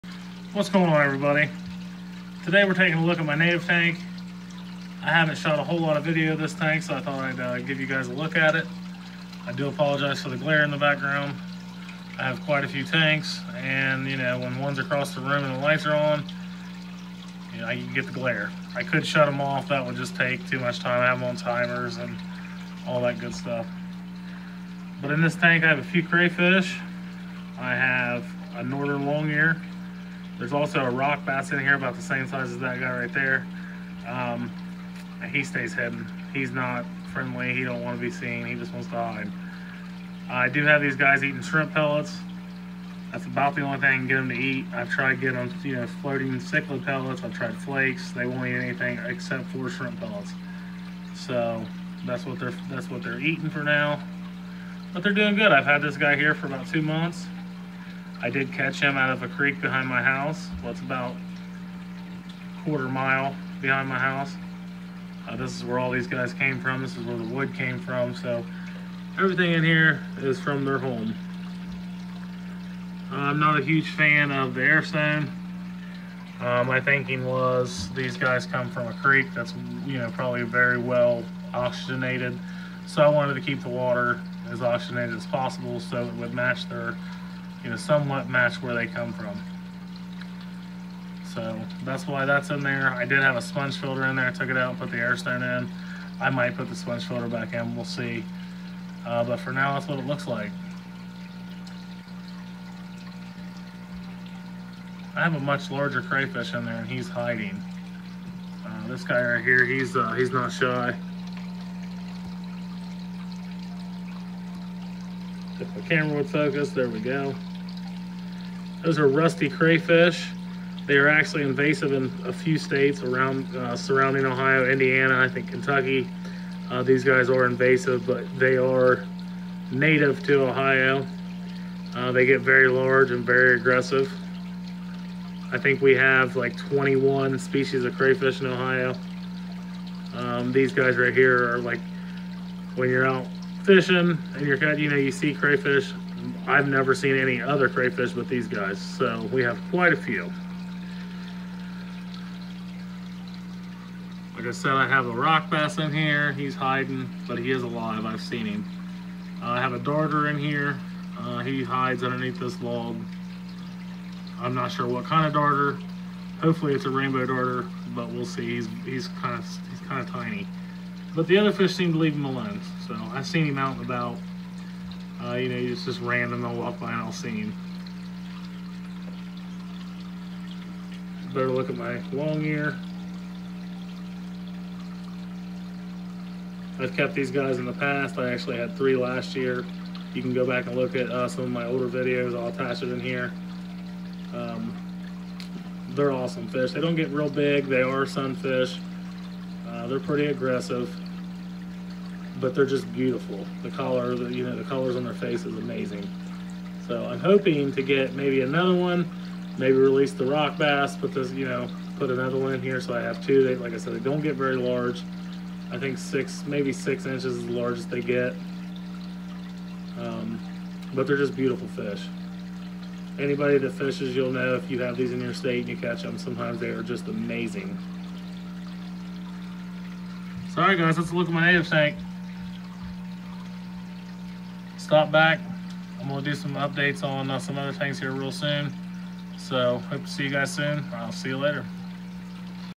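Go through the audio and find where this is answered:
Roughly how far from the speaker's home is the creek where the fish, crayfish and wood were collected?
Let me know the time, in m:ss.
1:02.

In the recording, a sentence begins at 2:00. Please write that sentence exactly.
They are actually invasive in a few states around uh, surrounding Ohio, Indiana, I think Kentucky.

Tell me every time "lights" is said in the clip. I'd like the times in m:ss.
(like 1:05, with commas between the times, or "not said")
0:15.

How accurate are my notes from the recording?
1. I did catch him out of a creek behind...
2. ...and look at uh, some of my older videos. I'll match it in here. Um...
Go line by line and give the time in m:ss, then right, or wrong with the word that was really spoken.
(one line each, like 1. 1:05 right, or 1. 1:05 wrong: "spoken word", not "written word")
1. 0:58 right
2. 3:10 wrong: "attach", not "match".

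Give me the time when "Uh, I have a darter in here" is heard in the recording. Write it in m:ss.
2:39.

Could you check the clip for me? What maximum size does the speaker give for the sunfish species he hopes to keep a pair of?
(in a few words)
6 inches.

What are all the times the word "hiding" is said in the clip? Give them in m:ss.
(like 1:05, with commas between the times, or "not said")
1:47, 2:36.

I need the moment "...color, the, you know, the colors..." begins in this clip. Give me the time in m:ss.
3:23.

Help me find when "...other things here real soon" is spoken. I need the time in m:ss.
3:57.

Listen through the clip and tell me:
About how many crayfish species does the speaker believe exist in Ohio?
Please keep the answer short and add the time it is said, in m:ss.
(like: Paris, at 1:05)
21, at 2:16.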